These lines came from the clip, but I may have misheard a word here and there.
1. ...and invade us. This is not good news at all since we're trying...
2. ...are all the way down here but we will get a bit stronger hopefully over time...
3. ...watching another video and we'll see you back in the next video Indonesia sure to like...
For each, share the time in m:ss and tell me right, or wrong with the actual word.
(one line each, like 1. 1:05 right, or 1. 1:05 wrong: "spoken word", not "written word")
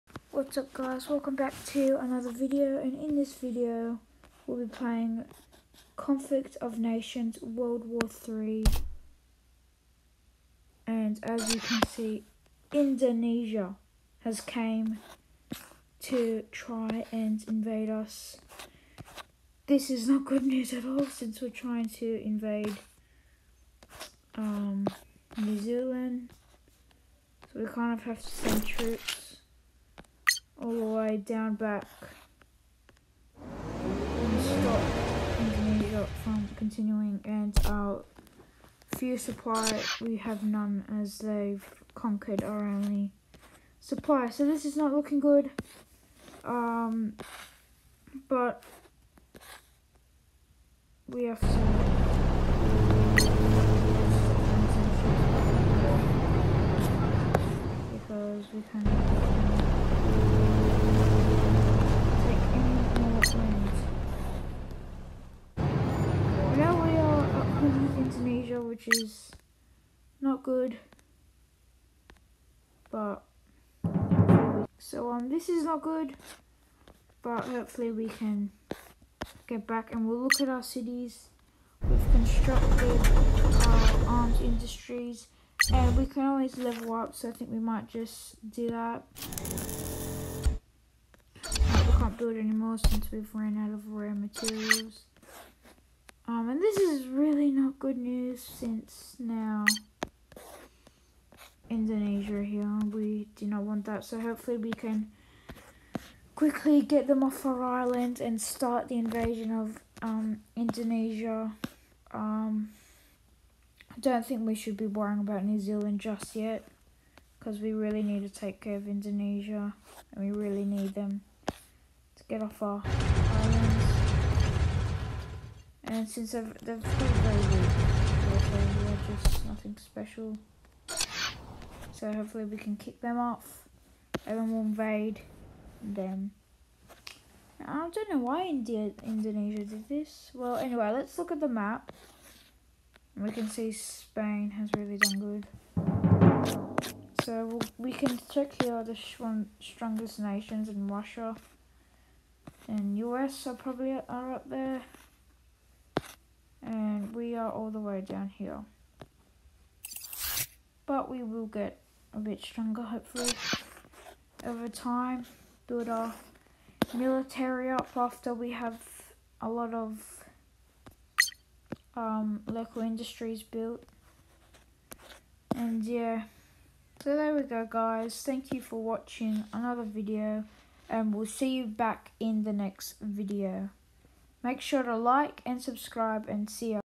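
1. 0:17 right
2. 2:37 right
3. 2:58 wrong: "Make", not "Indonesia".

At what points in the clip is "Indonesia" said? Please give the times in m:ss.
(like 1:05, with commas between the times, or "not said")
0:12, 1:41, 1:50, 1:58, 2:19.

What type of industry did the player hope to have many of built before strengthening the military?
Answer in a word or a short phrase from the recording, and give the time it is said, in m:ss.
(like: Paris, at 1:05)
Local industries, at 2:52.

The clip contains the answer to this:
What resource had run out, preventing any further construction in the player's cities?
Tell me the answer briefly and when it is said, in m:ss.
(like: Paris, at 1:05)
Rare materials, at 1:33.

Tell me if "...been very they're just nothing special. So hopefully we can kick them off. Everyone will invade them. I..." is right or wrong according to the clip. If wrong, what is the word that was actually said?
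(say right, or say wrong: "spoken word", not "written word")
right.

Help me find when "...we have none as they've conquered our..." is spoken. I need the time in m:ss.
0:39.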